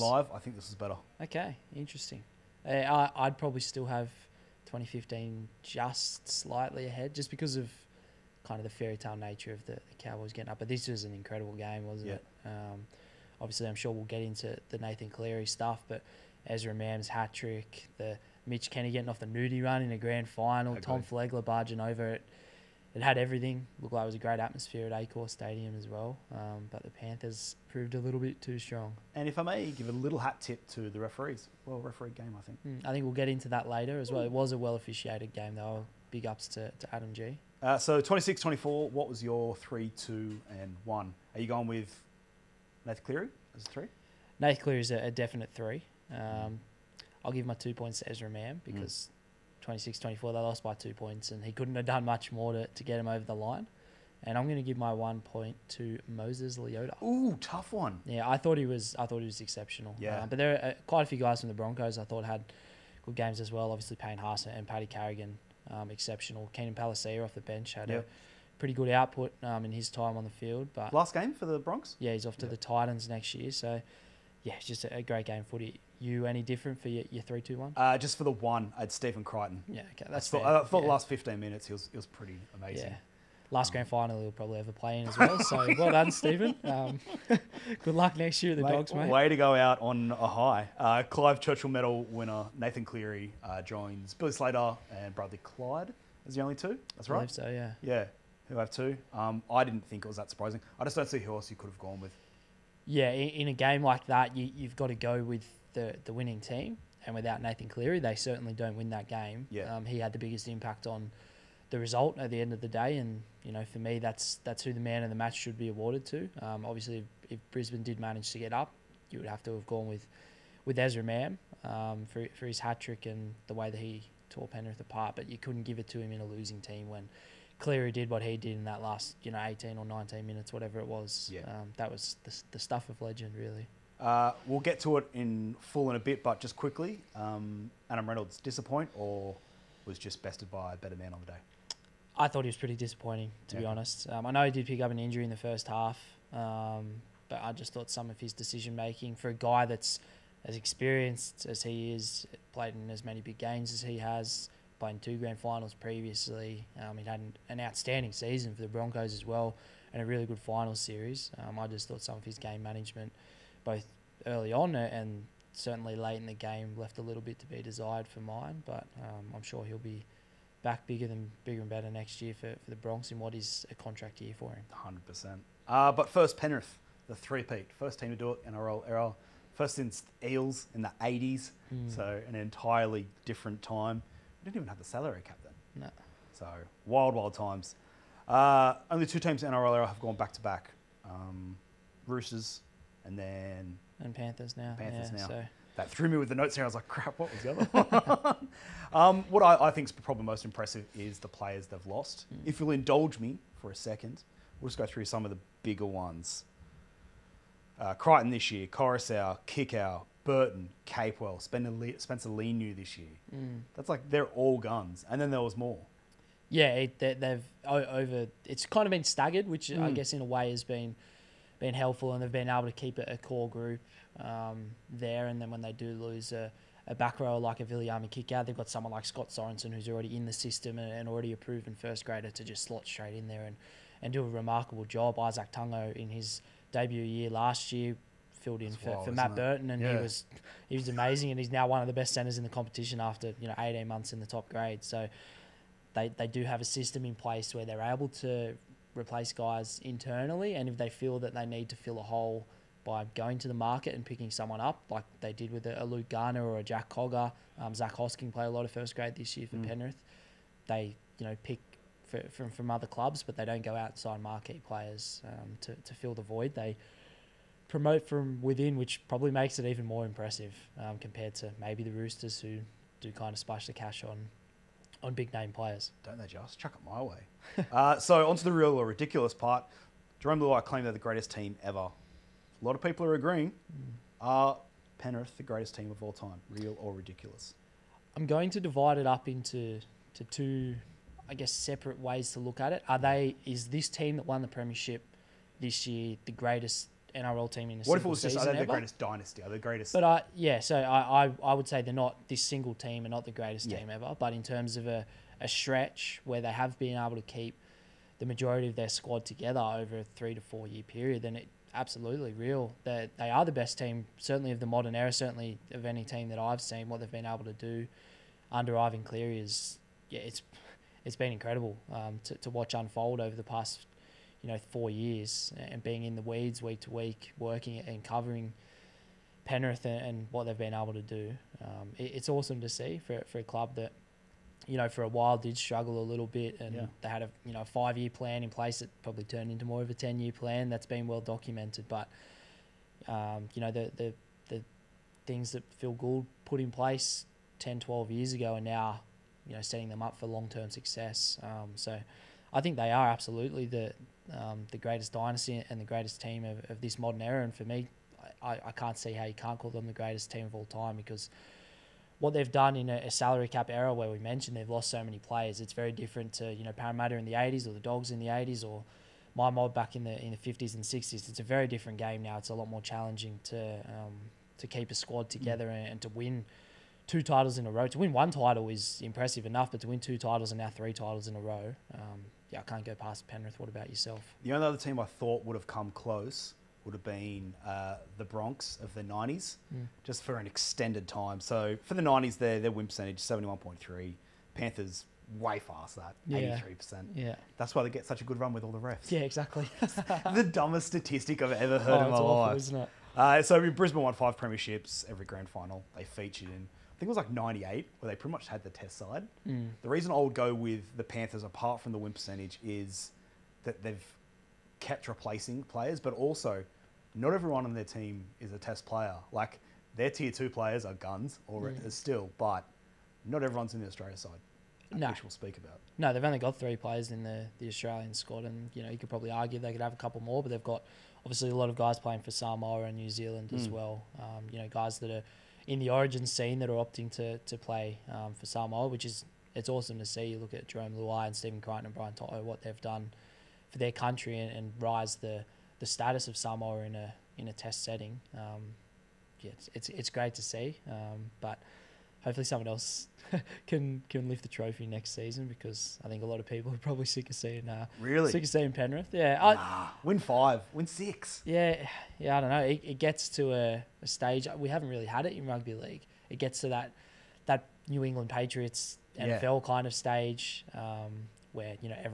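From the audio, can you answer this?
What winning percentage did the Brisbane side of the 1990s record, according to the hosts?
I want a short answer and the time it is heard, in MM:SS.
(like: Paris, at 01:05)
71.3, at 06:33.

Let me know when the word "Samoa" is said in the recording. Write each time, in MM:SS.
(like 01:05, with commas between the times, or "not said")
07:12, 07:18, 07:26.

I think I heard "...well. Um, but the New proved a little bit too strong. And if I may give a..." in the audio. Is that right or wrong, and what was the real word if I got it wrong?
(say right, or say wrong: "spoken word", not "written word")
wrong: "Panthers", not "New".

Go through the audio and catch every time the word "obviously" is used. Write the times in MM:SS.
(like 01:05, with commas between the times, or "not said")
00:13, 01:03, 01:56, 07:11.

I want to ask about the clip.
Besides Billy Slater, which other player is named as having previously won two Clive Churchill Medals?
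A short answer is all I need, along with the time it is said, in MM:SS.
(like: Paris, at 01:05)
Bradley Clyde, at 01:35.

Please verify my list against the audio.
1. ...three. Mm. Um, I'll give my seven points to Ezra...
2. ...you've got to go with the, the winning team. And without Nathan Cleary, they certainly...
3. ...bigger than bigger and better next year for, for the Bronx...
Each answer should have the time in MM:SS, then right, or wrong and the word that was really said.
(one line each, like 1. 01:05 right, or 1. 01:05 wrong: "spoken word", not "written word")
1. 00:45 wrong: "two", not "seven"
2. 01:44 right
3. 02:50 right.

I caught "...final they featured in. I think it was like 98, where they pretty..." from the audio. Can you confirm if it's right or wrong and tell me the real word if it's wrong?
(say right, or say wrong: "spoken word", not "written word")
right.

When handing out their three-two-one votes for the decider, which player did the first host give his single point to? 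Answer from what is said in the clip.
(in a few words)
Moses Leota.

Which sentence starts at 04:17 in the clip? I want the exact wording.
Um, Zach Hosking played a lot of first grade this year for mm.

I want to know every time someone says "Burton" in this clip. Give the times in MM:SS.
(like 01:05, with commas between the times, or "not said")
03:30, 03:59.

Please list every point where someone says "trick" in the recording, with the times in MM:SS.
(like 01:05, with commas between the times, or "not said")
00:17, 02:02.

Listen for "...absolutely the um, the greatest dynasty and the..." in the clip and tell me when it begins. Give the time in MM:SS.
05:53.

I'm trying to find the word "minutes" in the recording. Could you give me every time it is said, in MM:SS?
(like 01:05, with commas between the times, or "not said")
01:21, 02:10.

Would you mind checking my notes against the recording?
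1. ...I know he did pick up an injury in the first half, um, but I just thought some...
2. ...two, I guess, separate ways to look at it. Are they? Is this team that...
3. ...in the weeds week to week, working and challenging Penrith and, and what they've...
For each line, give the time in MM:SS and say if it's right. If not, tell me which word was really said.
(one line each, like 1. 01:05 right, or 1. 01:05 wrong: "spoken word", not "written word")
1. 02:24 right
2. 04:50 right
3. 05:26 wrong: "covering", not "challenging".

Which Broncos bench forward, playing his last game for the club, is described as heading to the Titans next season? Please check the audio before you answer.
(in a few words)
Keenan Palasia.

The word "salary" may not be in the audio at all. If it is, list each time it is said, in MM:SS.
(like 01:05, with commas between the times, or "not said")
03:04, 06:03.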